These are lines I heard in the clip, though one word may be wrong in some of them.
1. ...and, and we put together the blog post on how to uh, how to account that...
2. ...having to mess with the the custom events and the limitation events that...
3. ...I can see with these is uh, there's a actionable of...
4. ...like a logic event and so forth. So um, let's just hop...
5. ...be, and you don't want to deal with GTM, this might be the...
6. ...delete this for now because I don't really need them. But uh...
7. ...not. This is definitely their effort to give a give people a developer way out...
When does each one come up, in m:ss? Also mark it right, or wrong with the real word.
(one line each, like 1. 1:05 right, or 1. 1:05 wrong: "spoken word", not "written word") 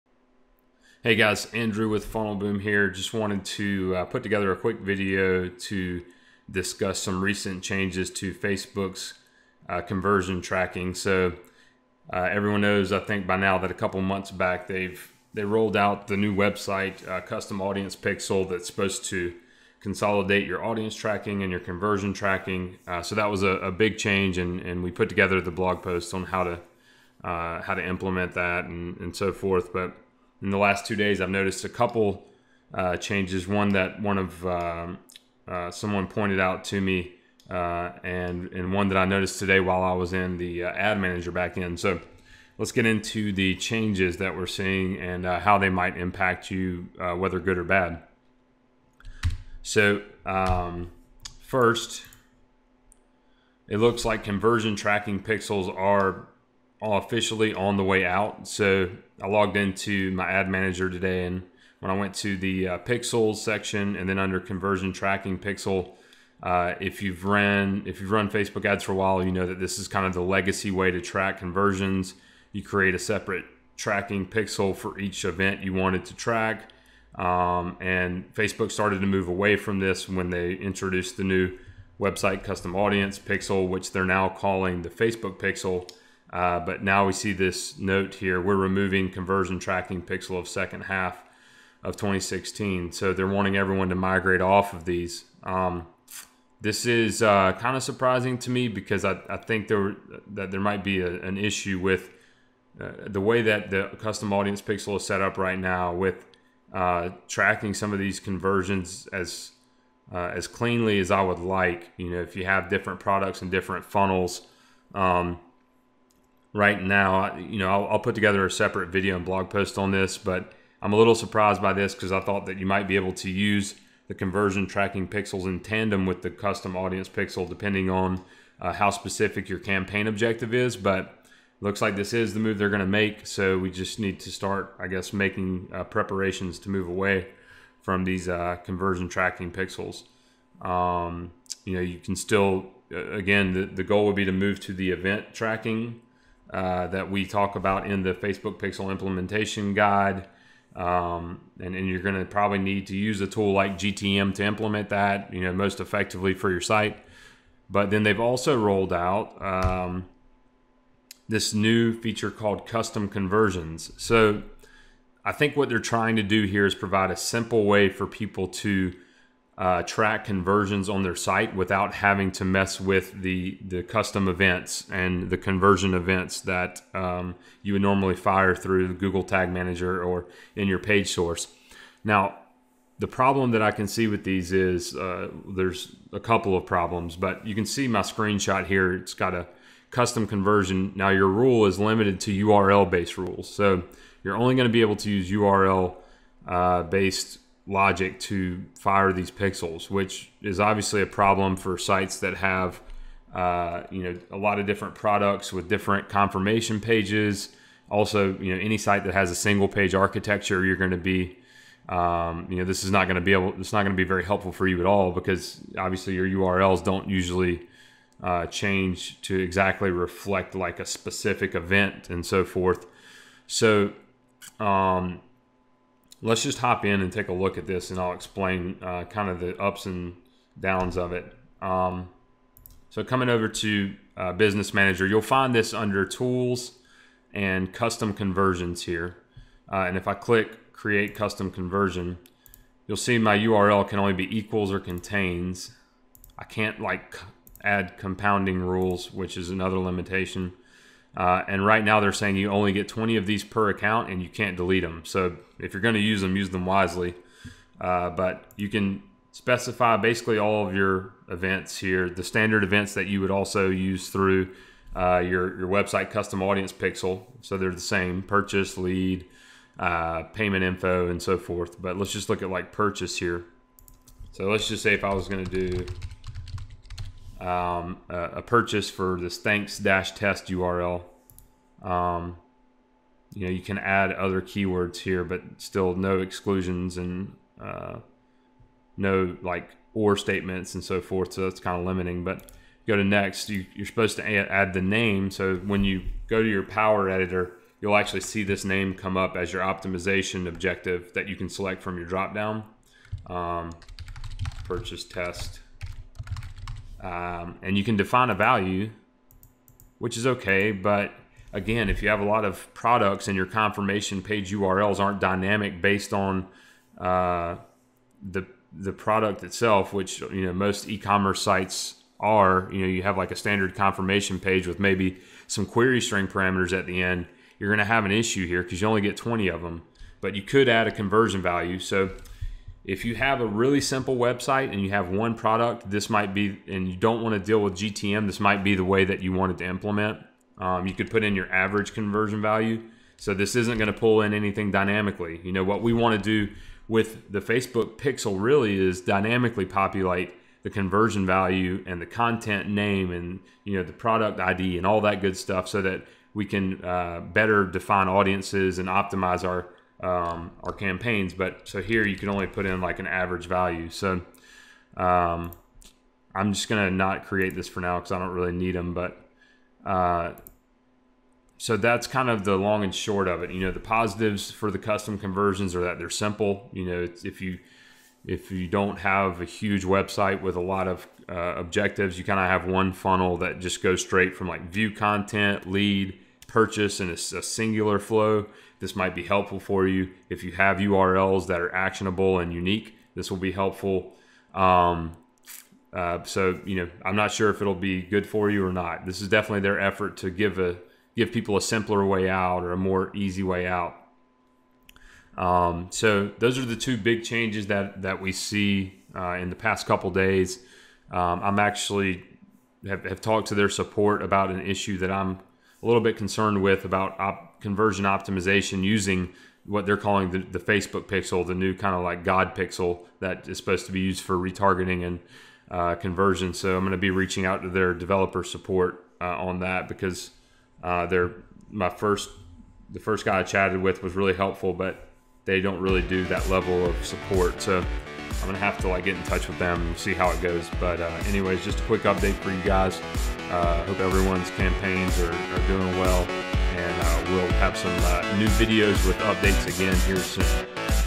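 1. 0:24 wrong: "implement", not "account"
2. 2:51 wrong: "conversion", not "limitation"
3. 3:03 wrong: "couple", not "actionable"
4. 3:40 wrong: "specific", not "logic"
5. 5:36 right
6. 6:07 wrong: "create", not "delete"
7. 6:38 wrong: "simpler", not "developer".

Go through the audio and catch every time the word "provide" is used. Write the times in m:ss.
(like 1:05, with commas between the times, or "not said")
2:46.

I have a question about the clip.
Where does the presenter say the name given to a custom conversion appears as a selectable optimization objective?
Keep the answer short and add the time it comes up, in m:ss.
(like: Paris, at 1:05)
power editor, at 4:56.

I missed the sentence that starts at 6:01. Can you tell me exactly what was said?
But so here you can only put in like an average value.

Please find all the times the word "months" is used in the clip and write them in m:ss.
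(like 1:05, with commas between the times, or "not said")
0:14.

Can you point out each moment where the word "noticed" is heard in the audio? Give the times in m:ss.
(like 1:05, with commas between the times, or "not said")
0:31, 0:39.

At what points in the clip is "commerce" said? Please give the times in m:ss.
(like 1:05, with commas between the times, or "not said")
5:20.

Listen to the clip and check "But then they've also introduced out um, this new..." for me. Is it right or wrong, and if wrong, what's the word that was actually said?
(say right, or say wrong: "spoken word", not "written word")
wrong: "rolled", not "introduced".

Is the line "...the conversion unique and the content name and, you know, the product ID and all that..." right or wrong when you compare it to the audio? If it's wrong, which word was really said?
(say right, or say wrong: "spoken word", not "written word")
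wrong: "value", not "unique".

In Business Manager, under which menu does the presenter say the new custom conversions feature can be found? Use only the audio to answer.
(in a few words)
Tools.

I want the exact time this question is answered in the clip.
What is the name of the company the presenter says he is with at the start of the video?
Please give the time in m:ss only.
0:02.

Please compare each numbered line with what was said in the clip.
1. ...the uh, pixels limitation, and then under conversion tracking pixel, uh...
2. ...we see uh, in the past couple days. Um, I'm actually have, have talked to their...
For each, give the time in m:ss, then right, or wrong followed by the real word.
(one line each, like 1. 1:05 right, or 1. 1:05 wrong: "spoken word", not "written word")
1. 1:02 wrong: "section", not "limitation"
2. 6:48 right.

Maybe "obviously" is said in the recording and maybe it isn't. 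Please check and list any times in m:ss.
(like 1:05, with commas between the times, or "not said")
3:20, 3:35.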